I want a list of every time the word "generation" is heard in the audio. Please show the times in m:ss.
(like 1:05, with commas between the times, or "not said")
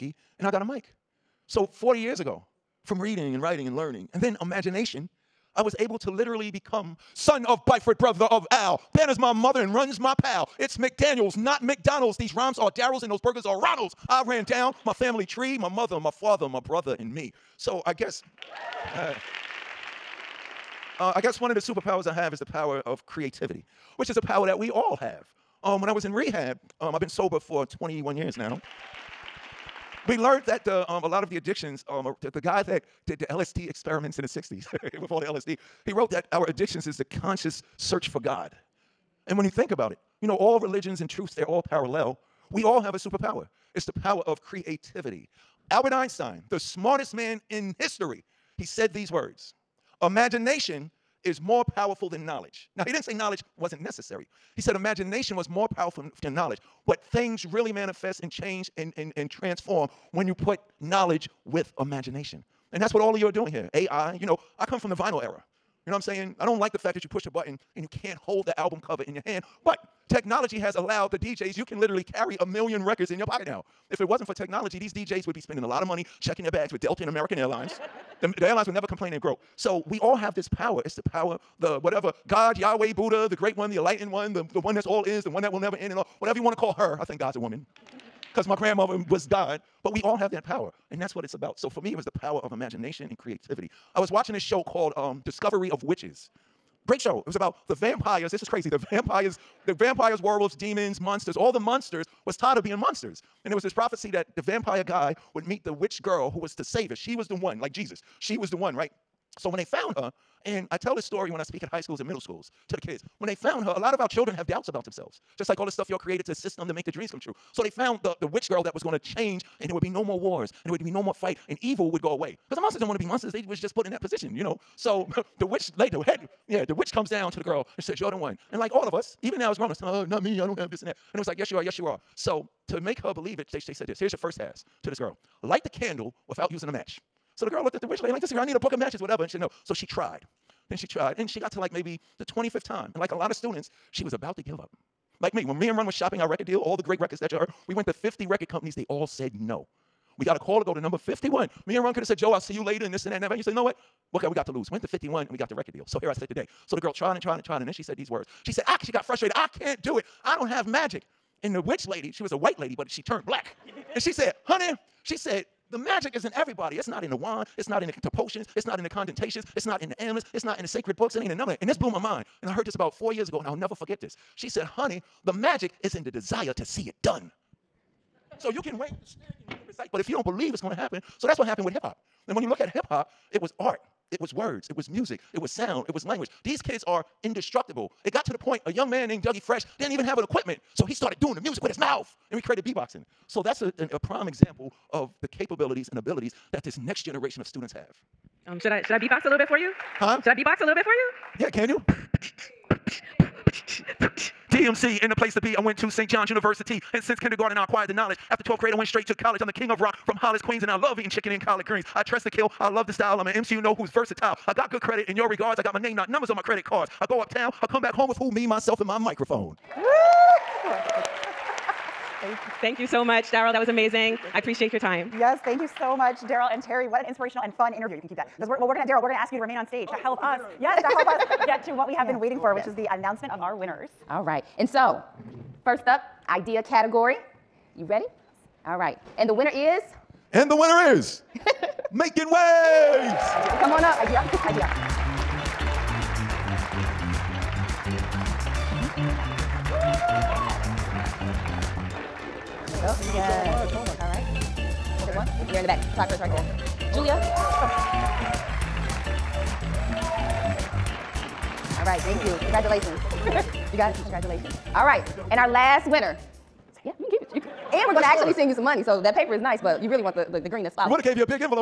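3:17.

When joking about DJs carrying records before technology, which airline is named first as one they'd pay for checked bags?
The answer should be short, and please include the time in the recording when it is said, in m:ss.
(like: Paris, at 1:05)
Delta, at 1:16.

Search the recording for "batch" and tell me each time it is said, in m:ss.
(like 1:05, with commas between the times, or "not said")
not said.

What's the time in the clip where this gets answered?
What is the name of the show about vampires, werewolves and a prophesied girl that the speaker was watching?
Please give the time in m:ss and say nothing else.
1:35.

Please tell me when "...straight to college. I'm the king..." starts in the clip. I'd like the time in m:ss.
3:28.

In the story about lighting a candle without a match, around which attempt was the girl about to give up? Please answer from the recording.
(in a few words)
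25th.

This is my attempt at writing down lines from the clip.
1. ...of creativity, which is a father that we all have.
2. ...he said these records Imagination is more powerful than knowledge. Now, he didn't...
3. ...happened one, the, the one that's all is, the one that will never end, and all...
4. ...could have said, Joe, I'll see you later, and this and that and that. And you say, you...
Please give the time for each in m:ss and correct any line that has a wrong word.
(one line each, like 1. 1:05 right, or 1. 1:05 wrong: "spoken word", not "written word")
1. 0:22 wrong: "power", not "father"
2. 0:48 wrong: "words", not "records"
3. 1:23 wrong: "enlightened", not "happened"
4. 2:31 right.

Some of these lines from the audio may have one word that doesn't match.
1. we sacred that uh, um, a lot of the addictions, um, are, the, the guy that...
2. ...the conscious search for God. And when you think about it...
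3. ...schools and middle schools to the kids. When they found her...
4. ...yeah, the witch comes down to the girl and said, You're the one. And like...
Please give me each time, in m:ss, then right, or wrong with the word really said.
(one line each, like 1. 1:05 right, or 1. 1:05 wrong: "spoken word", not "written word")
1. 0:30 wrong: "learned", not "sacred"
2. 0:36 right
3. 1:51 right
4. 2:06 right.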